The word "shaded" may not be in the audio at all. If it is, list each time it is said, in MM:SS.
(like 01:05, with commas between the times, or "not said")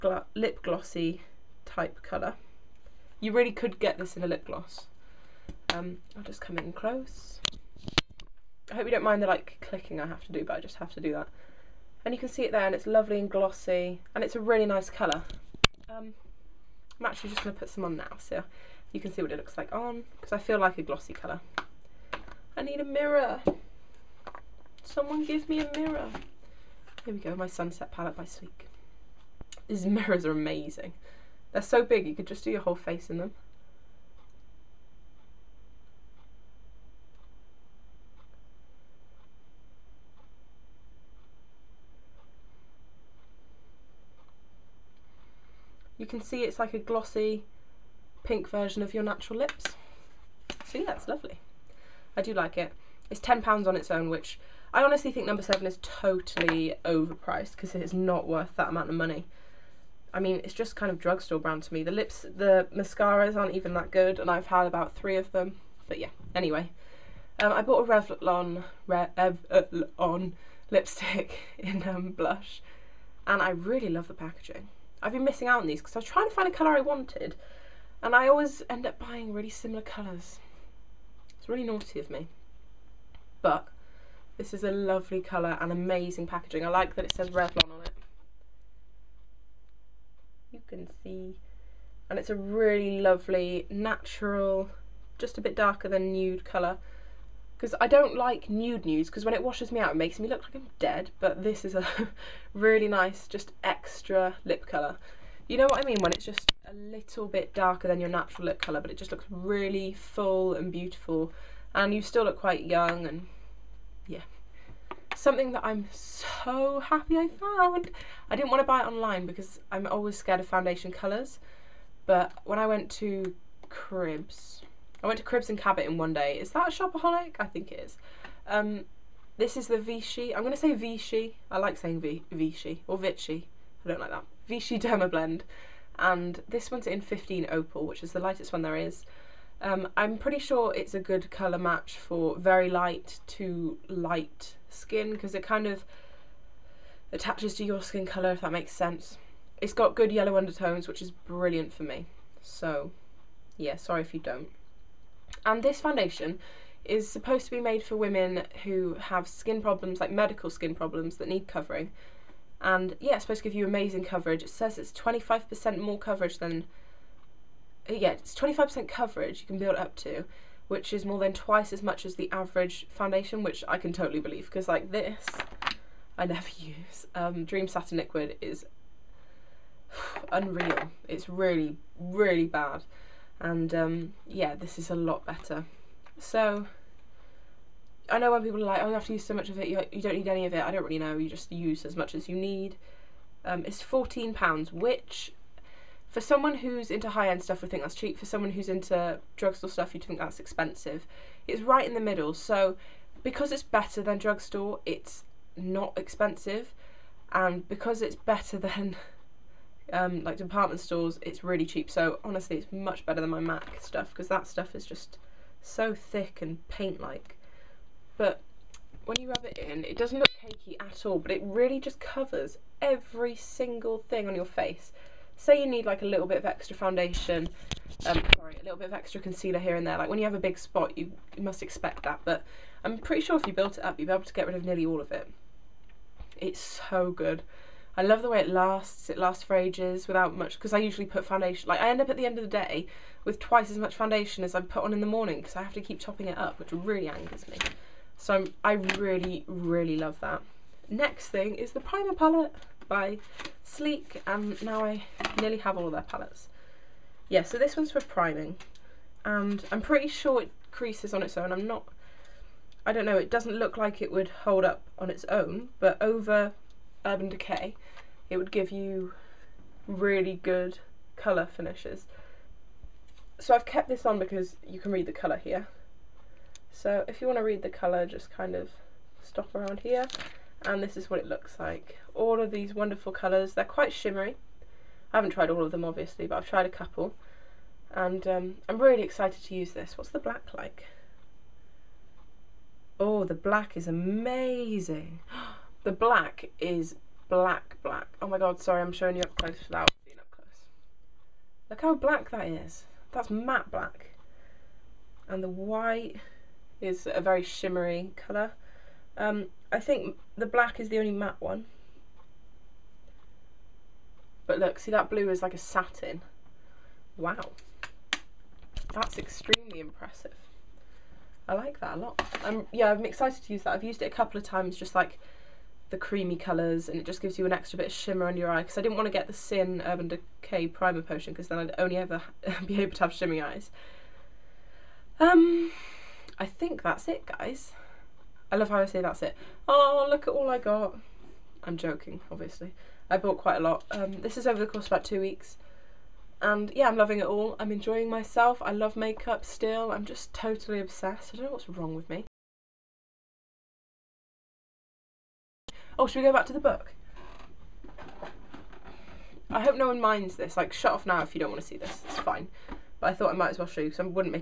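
not said.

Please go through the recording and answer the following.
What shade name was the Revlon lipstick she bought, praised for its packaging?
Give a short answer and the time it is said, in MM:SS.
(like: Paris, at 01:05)
Blush, at 01:12.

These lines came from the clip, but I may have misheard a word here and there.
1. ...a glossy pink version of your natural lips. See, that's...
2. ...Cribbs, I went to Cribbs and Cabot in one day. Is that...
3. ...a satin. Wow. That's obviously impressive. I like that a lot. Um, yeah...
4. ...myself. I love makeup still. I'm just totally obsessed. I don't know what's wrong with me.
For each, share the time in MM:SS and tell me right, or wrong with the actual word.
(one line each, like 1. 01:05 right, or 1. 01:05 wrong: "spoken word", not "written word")
1. 00:46 right
2. 02:03 right
3. 05:15 wrong: "extremely", not "obviously"
4. 05:48 right.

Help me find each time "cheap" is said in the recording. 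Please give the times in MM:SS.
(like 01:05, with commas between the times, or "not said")
03:17, 03:31.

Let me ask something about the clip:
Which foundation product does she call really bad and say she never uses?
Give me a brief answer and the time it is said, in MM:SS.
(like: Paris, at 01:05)
Dream Satin Liquid, at 02:57.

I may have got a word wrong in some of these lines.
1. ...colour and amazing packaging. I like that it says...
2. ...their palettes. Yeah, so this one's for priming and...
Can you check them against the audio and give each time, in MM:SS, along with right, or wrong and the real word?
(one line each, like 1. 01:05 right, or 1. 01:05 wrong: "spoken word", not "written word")
1. 01:25 right
2. 04:15 right.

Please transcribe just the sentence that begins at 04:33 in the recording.
So I've kept this on because you can read the colour here.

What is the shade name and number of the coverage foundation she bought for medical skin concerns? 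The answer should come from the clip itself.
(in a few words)
15 Opal.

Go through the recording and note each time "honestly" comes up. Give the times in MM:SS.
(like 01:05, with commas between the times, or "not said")
00:54, 03:32.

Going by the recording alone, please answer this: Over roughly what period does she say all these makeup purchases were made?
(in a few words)
About two weeks.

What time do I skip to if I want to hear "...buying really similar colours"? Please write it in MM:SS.
01:18.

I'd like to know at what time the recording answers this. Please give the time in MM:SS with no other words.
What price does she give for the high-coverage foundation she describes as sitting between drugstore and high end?
03:13.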